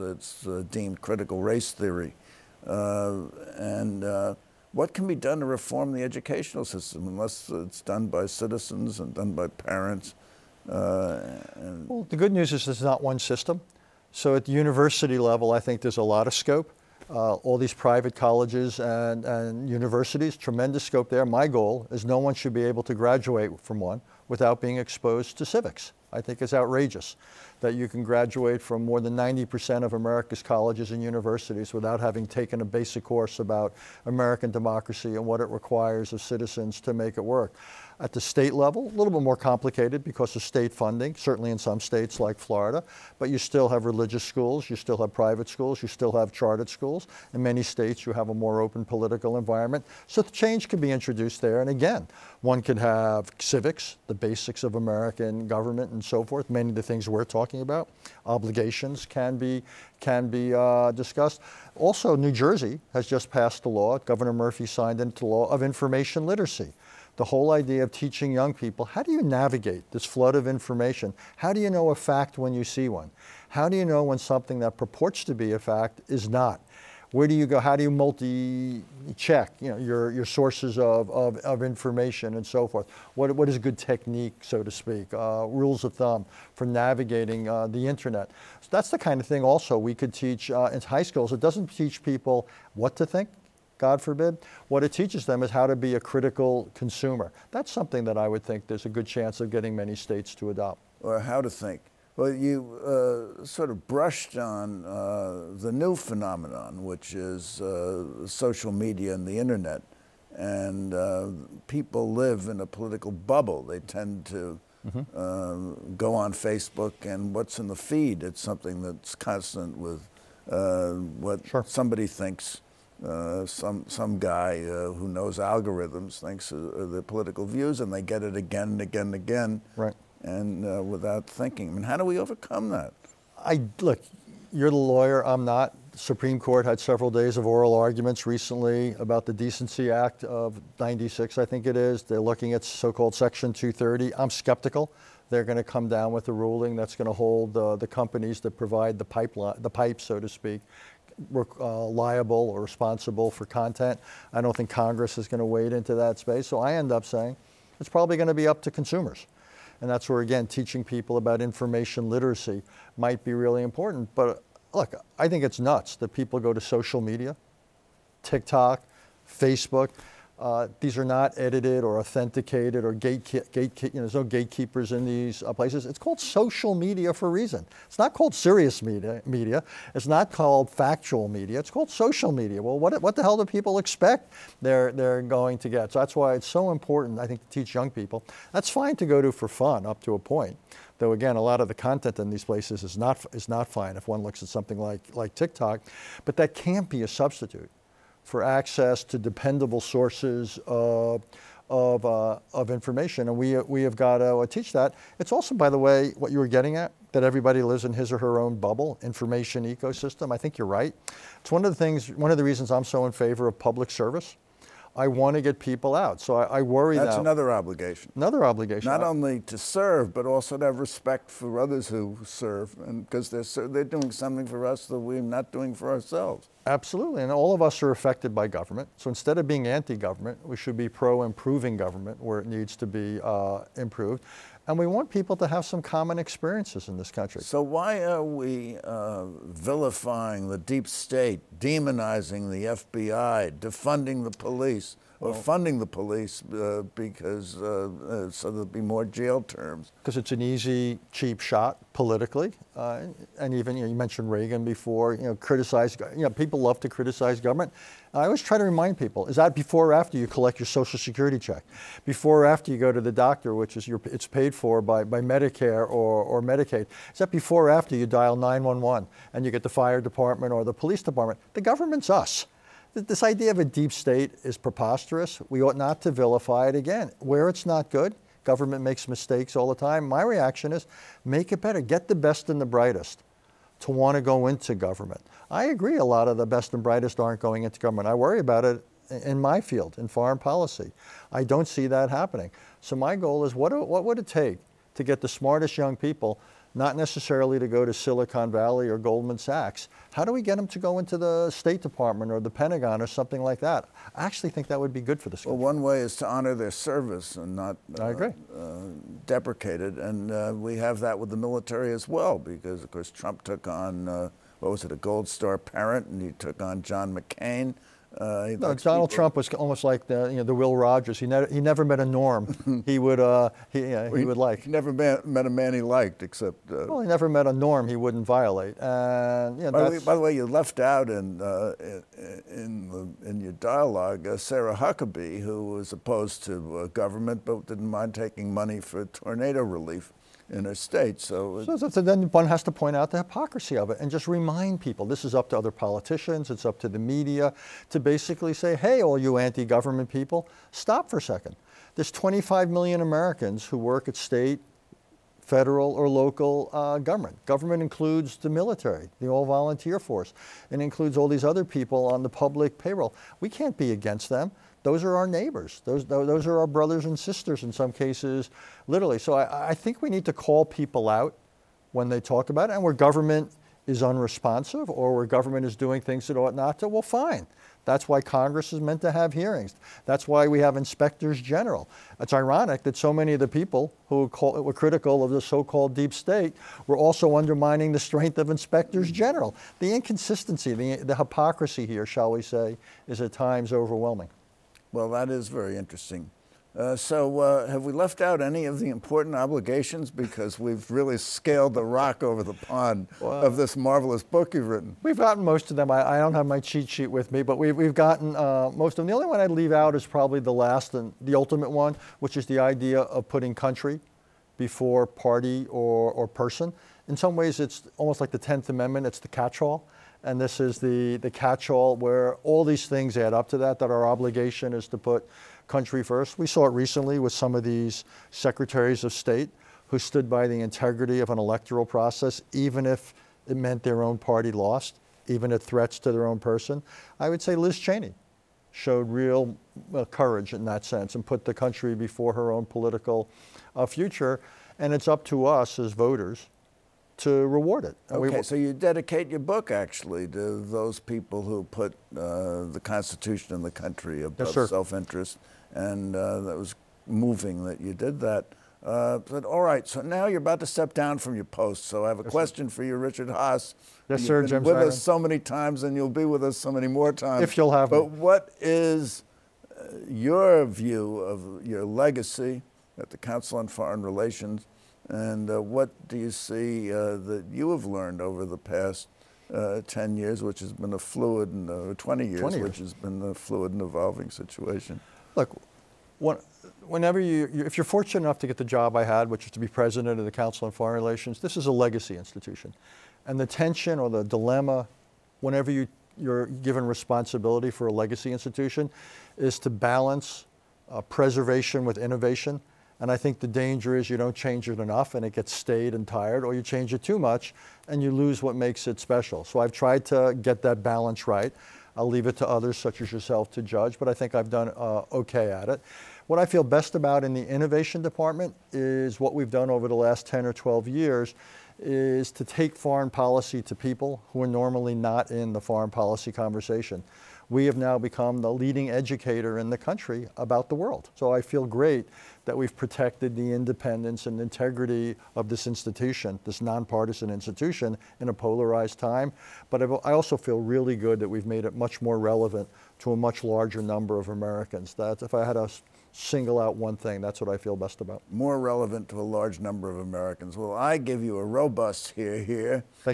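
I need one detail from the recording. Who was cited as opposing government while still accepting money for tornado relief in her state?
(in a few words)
Sarah Huckabee.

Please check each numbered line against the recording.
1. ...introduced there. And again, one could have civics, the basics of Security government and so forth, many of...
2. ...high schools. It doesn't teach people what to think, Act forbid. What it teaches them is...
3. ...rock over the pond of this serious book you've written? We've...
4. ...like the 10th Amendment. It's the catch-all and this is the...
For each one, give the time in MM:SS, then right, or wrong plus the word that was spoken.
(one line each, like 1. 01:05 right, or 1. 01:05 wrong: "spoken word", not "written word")
1. 00:50 wrong: "American", not "Security"
2. 01:30 wrong: "God", not "Act"
3. 06:41 wrong: "marvelous", not "serious"
4. 06:58 right.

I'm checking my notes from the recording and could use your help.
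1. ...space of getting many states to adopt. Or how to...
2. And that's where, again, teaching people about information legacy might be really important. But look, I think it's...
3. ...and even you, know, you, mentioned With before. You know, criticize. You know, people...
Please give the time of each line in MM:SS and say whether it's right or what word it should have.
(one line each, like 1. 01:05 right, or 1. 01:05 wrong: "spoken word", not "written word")
1. 01:39 wrong: "chance", not "space"
2. 02:39 wrong: "literacy", not "legacy"
3. 04:13 wrong: "Reagan", not "With".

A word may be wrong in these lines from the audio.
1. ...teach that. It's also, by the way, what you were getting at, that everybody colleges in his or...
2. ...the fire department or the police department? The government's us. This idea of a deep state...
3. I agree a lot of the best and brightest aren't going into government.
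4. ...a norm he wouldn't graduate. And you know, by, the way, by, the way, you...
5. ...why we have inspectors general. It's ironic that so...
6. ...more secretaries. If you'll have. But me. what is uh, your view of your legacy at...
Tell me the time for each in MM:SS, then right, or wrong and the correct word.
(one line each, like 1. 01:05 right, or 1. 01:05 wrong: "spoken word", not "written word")
1. 03:24 wrong: "lives", not "colleges"
2. 04:29 right
3. 04:45 right
4. 05:27 wrong: "violate", not "graduate"
5. 06:20 right
6. 07:46 wrong: "times", not "secretaries".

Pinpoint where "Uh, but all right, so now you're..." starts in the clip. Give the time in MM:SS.
07:38.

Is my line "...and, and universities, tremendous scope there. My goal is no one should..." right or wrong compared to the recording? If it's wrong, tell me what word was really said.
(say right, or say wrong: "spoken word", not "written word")
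right.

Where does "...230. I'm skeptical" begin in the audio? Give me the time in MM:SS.
02:23.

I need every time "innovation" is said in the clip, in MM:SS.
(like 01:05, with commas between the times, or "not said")
08:21, 08:37.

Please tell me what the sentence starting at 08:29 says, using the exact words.
So I've tried to get that balance right.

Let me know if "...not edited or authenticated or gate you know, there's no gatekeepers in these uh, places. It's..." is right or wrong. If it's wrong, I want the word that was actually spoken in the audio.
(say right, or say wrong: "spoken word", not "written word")
right.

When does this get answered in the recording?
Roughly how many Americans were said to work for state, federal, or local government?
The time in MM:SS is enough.
05:52.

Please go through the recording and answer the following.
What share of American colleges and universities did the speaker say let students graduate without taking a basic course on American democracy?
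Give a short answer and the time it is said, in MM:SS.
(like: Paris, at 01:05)
more than 90%, at 00:28.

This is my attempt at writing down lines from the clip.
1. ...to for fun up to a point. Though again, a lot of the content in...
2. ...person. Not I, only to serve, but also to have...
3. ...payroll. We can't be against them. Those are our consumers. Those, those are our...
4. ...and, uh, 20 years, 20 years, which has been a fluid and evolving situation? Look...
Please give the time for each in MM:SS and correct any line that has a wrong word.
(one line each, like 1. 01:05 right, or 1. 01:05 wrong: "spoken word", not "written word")
1. 03:09 right
2. 03:38 wrong: "obligation", not "person"
3. 06:02 wrong: "neighbors", not "consumers"
4. 08:01 right.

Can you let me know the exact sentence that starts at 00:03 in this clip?
and what can be done to reform the educational system unless it's done by citizens and done by parents?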